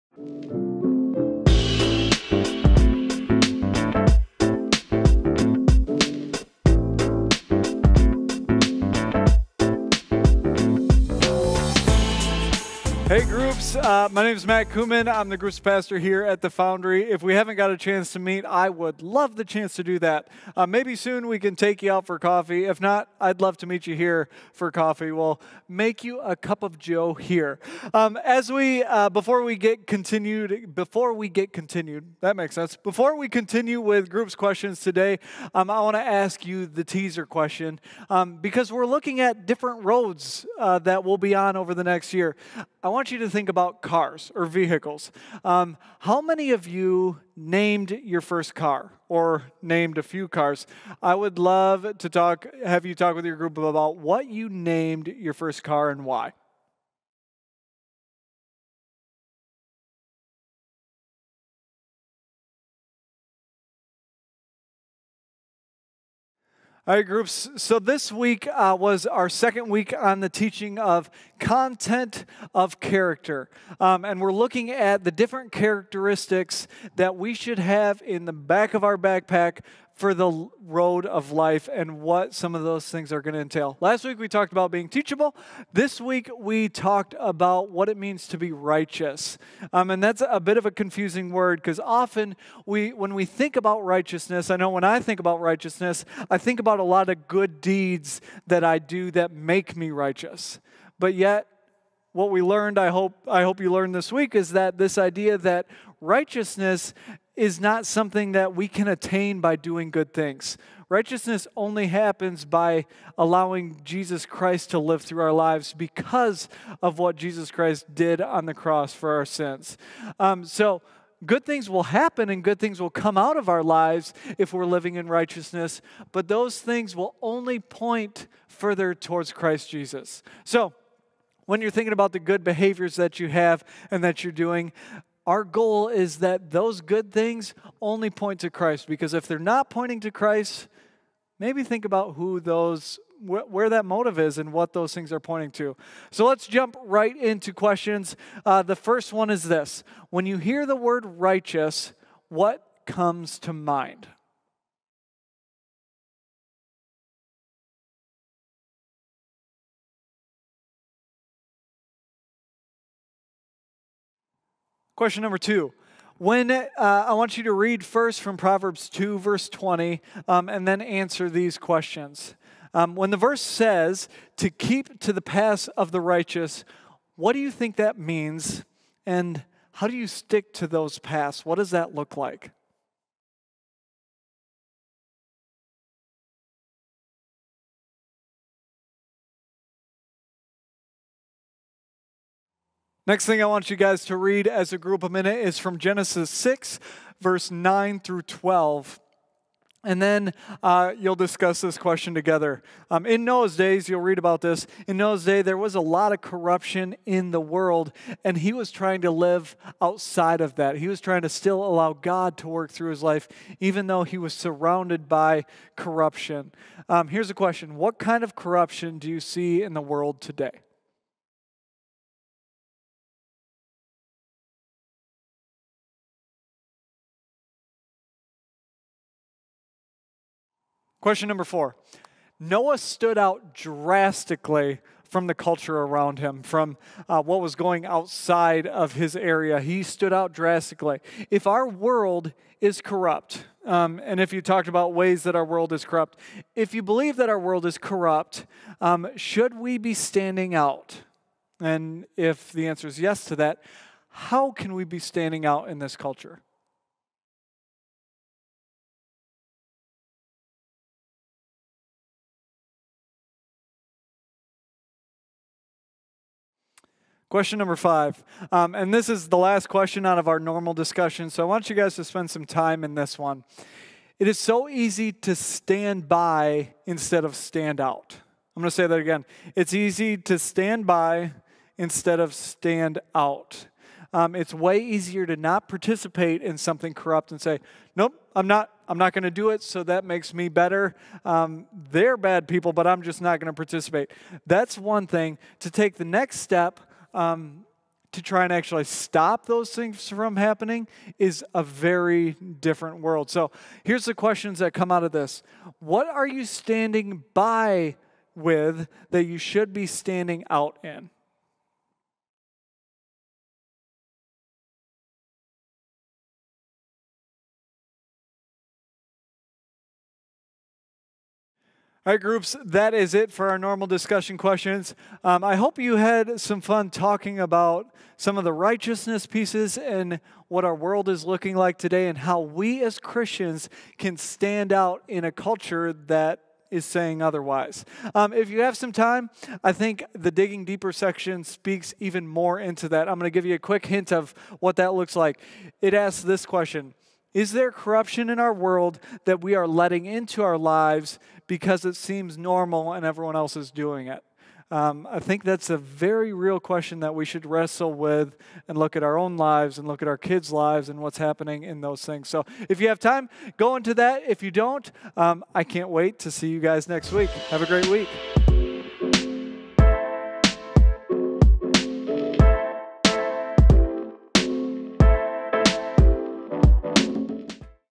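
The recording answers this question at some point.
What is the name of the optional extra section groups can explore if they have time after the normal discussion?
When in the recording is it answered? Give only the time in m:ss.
5:40.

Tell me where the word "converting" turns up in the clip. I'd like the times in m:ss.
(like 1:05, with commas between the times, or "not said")
not said.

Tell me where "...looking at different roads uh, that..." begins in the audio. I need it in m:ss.
0:38.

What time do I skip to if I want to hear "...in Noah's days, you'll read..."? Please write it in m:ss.
3:23.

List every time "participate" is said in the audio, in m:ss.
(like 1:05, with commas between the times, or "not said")
4:45, 4:53.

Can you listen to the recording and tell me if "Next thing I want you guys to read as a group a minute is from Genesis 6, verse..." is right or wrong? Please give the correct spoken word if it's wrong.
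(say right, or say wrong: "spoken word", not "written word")
right.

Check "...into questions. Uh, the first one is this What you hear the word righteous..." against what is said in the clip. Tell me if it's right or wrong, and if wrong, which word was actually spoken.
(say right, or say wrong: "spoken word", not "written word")
wrong: "When", not "What".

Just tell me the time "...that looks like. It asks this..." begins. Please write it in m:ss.
5:44.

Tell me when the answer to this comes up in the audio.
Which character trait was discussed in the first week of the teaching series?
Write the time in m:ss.
1:24.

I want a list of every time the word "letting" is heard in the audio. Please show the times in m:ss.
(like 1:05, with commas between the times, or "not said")
5:49.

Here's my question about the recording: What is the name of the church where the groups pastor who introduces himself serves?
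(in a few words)
The Foundry.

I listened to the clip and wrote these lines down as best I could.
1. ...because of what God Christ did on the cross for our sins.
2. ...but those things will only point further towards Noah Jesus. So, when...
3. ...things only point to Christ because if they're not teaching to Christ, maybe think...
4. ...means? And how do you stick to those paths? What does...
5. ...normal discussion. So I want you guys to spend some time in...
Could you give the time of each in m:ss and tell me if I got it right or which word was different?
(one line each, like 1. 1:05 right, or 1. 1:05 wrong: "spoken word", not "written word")
1. 1:55 wrong: "Jesus", not "God"
2. 2:06 wrong: "Christ", not "Noah"
3. 2:17 wrong: "pointing", not "teaching"
4. 2:57 right
5. 4:30 right.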